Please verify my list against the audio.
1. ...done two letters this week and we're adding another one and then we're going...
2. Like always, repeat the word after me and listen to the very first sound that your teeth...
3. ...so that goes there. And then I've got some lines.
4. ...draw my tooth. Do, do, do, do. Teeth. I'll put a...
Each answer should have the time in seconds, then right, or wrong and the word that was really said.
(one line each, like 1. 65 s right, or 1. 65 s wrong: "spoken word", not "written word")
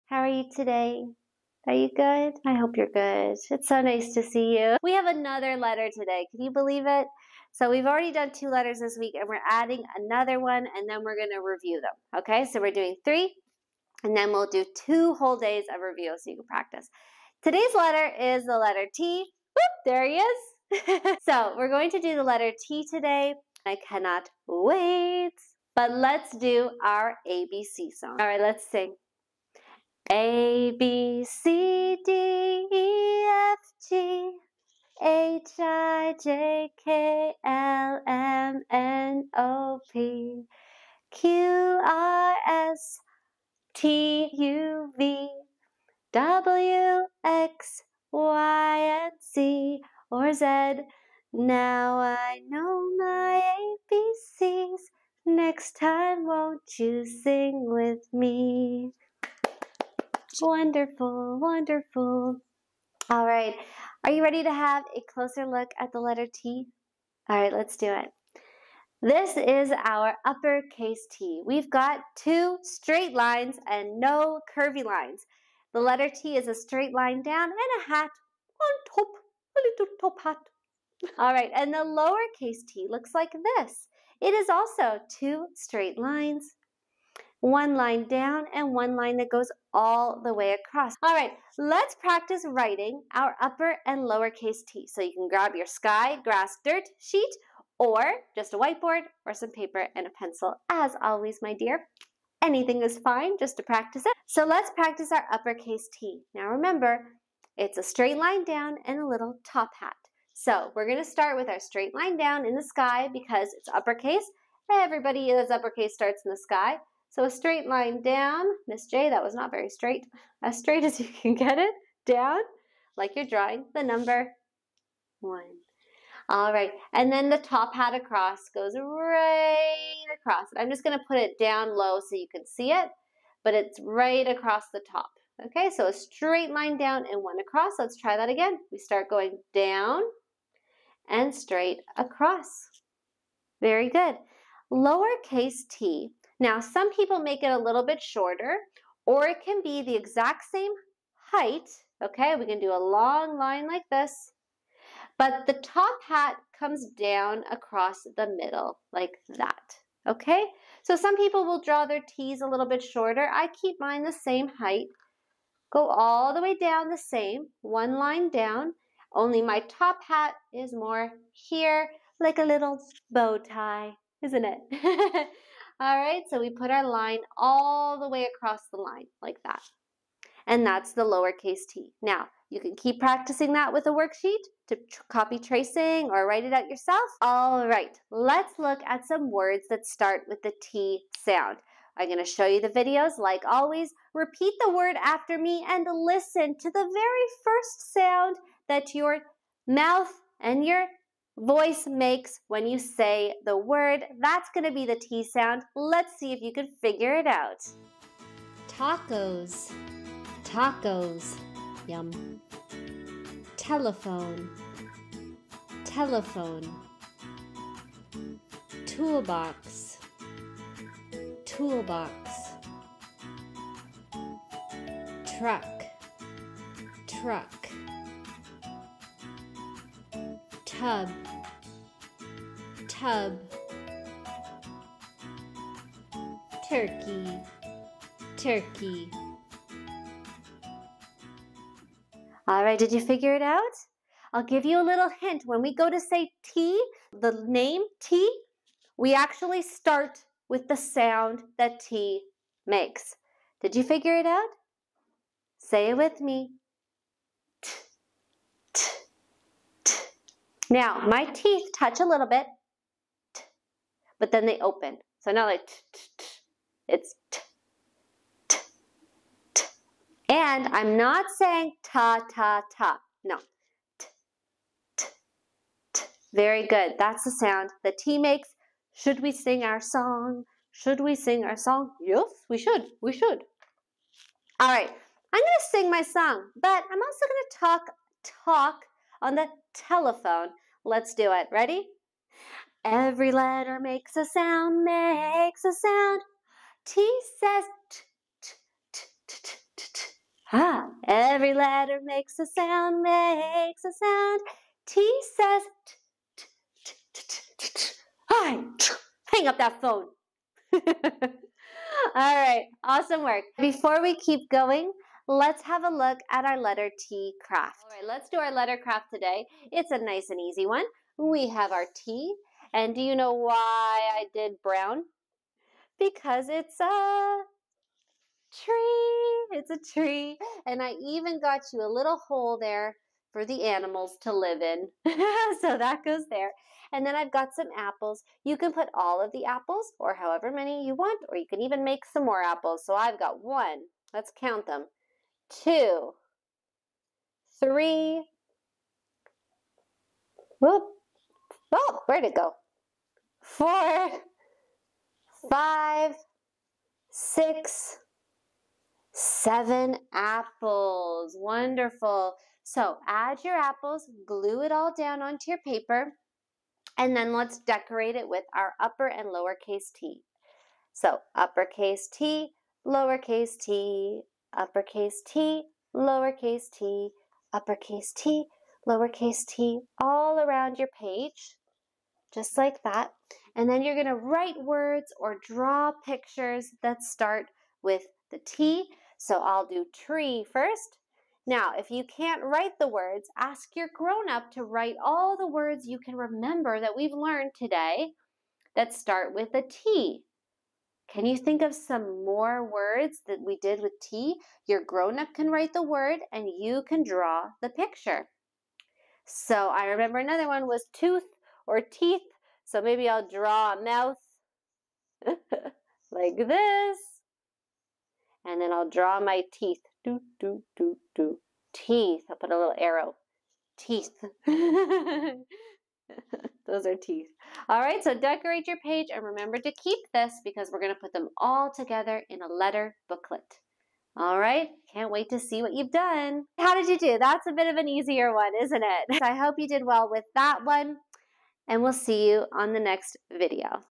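1. 8 s right
2. 193 s wrong: "mouth", not "teeth"
3. 335 s wrong: "apples", not "lines"
4. 418 s wrong: "teeth", not "tooth".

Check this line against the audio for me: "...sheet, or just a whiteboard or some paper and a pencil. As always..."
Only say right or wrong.
right.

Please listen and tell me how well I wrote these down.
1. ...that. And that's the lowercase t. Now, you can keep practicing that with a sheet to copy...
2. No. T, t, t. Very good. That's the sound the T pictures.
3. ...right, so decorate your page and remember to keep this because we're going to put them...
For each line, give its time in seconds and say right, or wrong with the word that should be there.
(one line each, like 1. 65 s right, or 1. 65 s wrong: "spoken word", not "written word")
1. 179 s wrong: "worksheet", not "sheet"
2. 273 s wrong: "makes", not "pictures"
3. 427 s right.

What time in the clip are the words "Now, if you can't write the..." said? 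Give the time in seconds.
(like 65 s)
391 s.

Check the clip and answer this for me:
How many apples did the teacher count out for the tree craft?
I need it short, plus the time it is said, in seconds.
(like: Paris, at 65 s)
7, at 359 s.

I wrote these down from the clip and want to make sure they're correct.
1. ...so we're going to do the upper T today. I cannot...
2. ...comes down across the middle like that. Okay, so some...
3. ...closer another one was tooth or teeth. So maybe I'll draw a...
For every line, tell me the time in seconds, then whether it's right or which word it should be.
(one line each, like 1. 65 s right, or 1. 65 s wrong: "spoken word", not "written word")
1. 21 s wrong: "letter", not "upper"
2. 156 s right
3. 409 s wrong: "remember", not "closer".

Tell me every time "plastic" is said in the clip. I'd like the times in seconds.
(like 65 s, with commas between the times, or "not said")
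not said.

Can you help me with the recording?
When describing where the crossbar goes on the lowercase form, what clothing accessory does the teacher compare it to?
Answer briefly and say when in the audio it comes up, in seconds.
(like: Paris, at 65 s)
bow tie, at 172 s.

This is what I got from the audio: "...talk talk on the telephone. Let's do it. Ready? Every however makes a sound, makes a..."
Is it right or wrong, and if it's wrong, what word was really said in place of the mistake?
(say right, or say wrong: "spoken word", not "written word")
wrong: "letter", not "however".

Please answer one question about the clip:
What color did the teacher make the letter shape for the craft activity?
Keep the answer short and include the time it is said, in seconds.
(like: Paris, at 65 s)
Brown, at 324 s.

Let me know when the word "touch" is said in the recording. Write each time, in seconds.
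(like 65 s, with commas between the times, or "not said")
261 s.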